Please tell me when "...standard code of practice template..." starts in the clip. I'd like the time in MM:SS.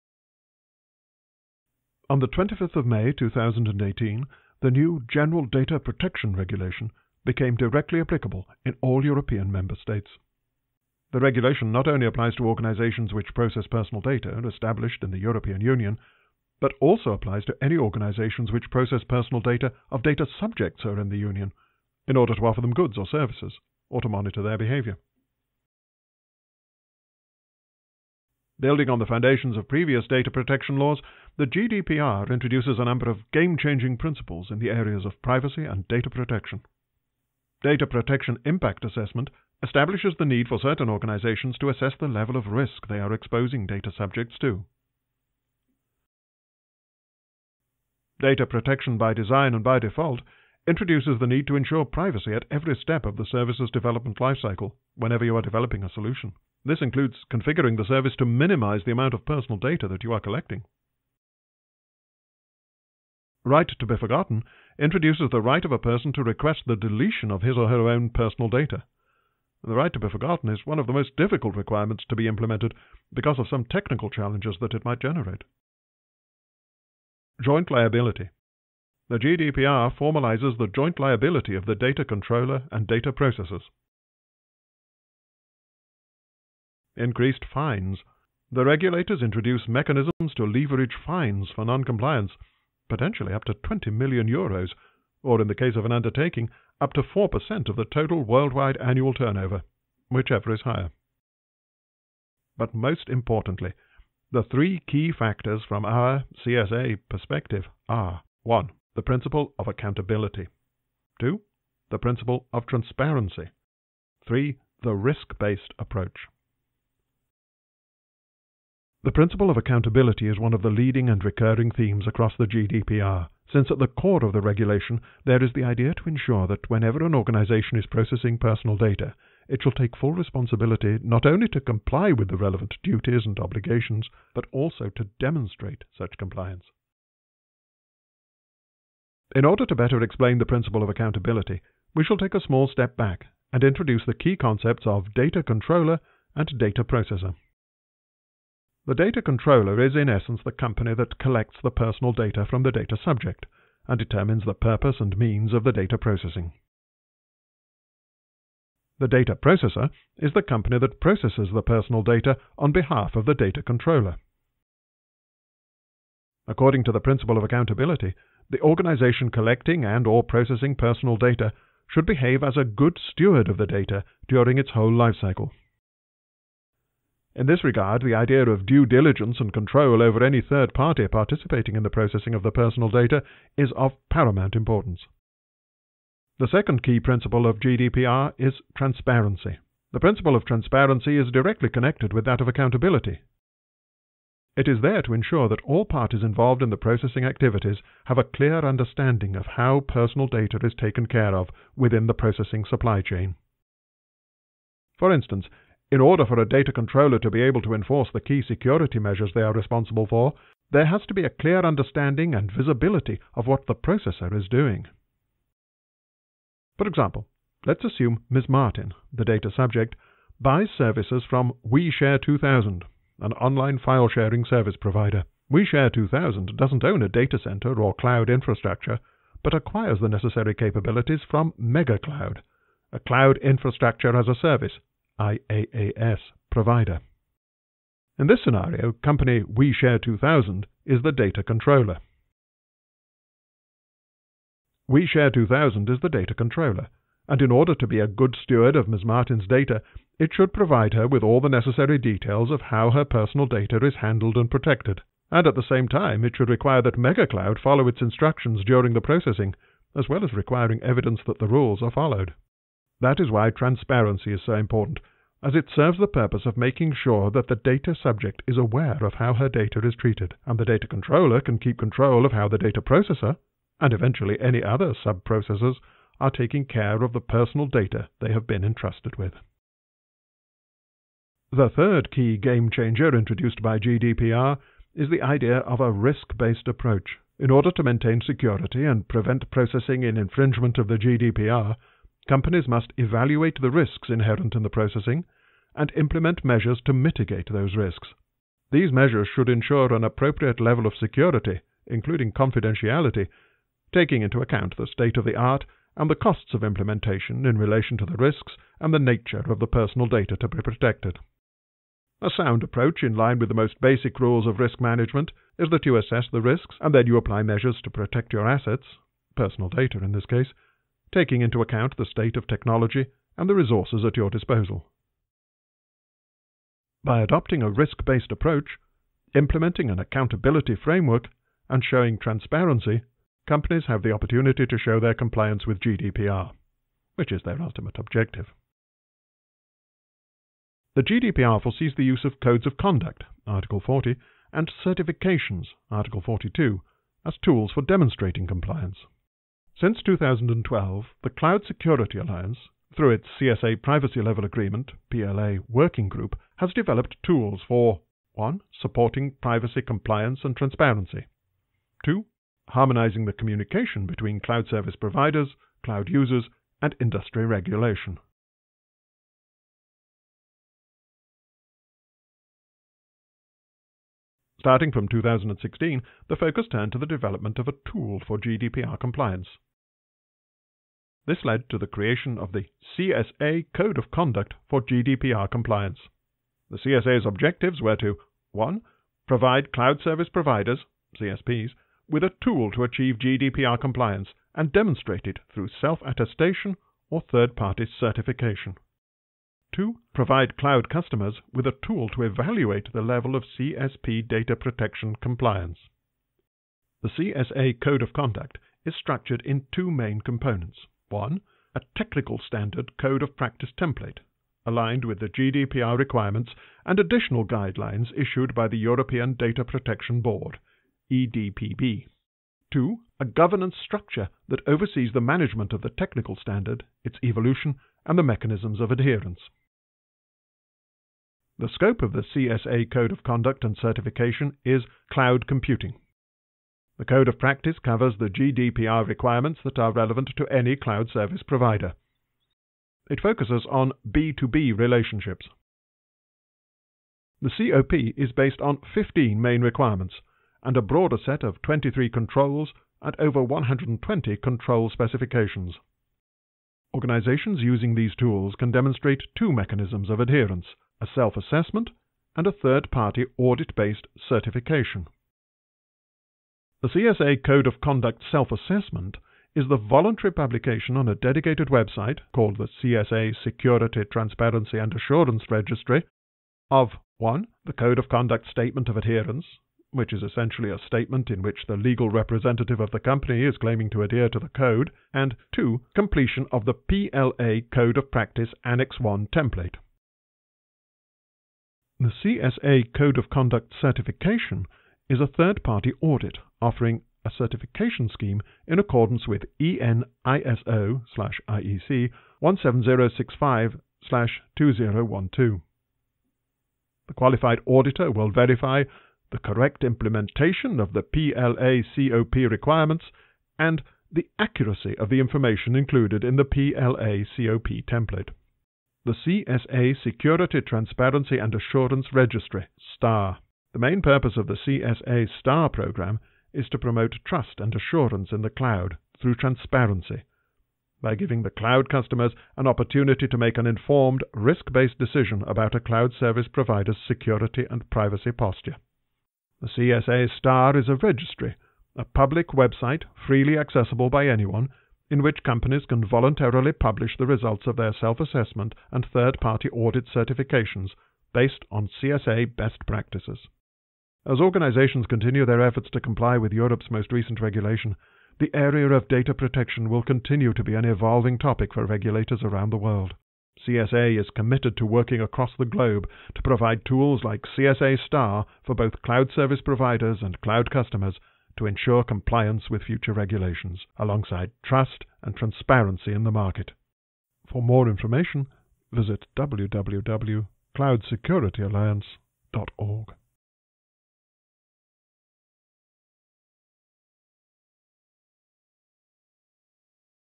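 06:52.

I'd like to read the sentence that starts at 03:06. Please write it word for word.
The second key principle of GDPR is transparency.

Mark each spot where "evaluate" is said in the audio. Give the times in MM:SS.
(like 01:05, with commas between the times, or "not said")
04:52, 06:42.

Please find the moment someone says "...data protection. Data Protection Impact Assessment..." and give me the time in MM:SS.
00:35.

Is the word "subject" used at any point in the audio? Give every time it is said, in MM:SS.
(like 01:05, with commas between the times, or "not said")
00:20, 00:43, 02:32, 03:39, 04:27.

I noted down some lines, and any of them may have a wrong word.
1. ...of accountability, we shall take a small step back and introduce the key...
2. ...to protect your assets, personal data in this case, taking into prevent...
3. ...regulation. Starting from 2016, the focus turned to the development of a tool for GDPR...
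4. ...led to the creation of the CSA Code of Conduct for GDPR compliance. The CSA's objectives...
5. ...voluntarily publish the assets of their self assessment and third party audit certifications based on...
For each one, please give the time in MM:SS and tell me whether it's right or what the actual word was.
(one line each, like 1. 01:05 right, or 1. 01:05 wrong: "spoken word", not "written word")
1. 02:20 right
2. 05:17 wrong: "account", not "prevent"
3. 06:07 right
4. 06:21 right
5. 09:06 wrong: "results", not "assets".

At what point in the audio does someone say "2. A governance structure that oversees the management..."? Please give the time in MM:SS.
07:02.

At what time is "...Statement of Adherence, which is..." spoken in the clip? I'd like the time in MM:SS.
07:58.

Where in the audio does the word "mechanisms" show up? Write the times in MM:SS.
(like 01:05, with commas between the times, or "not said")
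01:29, 07:08, 07:39.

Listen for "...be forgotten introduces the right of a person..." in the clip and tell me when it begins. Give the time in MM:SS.
01:03.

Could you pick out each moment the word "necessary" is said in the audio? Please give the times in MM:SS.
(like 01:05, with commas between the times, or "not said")
03:50, 04:11.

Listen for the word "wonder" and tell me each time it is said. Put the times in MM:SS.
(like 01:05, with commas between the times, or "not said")
not said.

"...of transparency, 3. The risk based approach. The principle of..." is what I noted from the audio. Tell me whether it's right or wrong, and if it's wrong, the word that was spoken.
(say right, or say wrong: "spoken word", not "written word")
right.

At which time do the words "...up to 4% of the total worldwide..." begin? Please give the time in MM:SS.
01:36.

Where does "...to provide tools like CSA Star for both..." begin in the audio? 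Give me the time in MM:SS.
09:26.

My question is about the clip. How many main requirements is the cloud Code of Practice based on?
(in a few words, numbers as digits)
15.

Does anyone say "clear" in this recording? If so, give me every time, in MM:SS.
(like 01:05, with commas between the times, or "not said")
03:18, 03:31.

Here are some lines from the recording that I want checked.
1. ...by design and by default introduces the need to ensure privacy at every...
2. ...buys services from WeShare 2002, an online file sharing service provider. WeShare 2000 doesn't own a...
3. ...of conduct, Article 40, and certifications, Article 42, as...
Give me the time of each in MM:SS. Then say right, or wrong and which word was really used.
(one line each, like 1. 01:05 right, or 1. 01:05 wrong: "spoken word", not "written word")
1. 00:48 right
2. 03:40 wrong: "2000", not "2002"
3. 05:42 right.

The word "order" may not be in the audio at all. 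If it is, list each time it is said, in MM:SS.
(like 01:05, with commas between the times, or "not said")
00:22, 02:19, 03:25, 04:07, 04:47.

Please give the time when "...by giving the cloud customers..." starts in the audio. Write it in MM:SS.
08:51.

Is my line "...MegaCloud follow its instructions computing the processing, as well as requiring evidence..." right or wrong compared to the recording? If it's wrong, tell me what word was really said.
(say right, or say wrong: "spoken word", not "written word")
wrong: "during", not "computing".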